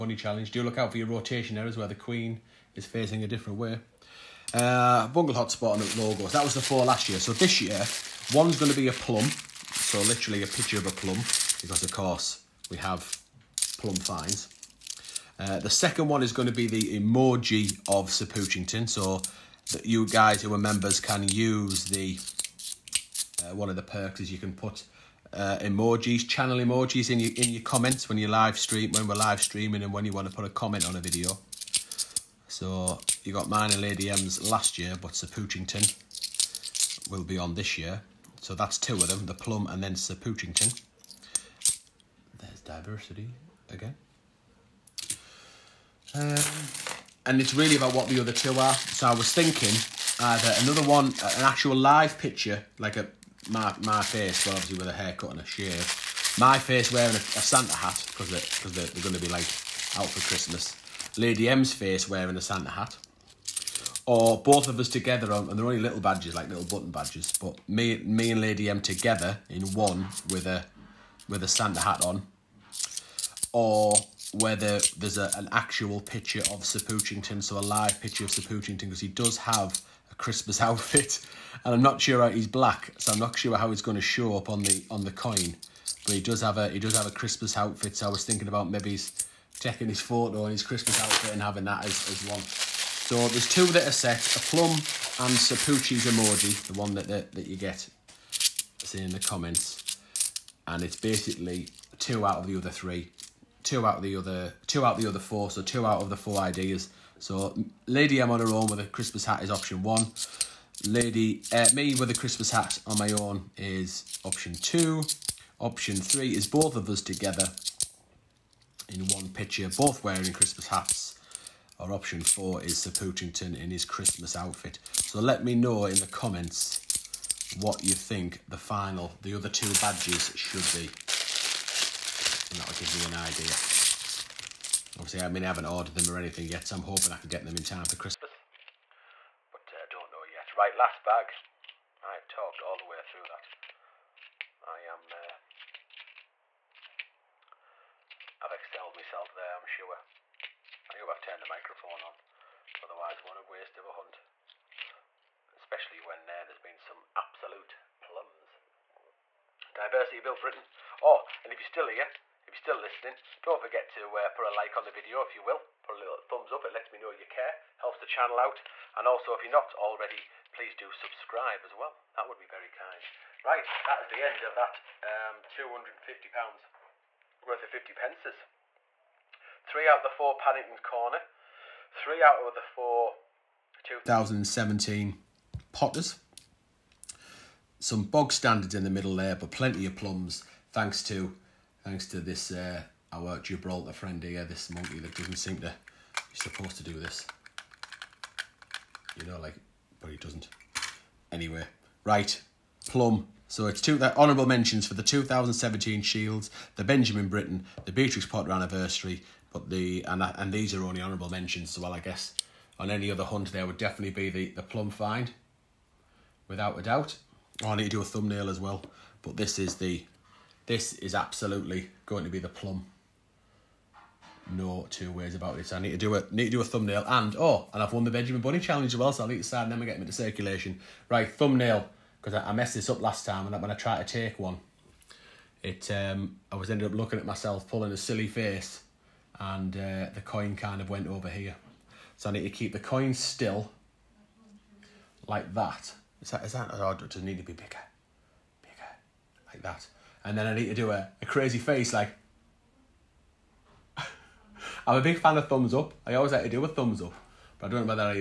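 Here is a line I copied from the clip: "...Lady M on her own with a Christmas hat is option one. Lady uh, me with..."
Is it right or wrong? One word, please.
right.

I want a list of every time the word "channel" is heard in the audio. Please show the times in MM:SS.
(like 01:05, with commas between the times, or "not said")
00:26, 02:48.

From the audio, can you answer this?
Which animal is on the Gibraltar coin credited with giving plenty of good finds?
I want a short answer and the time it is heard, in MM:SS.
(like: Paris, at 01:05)
Monkey, at 03:14.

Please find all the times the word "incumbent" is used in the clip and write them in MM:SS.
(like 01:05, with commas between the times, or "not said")
not said.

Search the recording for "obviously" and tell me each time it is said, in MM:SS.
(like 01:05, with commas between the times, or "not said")
00:54, 02:14.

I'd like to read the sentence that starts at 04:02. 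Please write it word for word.
So I need to keep the coin still, like that.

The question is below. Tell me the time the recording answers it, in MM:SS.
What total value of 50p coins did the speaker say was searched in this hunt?
02:55.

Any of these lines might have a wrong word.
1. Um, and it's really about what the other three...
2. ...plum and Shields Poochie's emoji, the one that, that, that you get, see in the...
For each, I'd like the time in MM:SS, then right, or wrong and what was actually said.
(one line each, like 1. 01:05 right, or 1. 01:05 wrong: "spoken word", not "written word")
1. 00:46 wrong: "two", not "three"
2. 01:34 wrong: "Sir", not "Shields".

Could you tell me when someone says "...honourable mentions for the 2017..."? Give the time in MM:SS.
03:24.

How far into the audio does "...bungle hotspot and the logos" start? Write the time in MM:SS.
00:05.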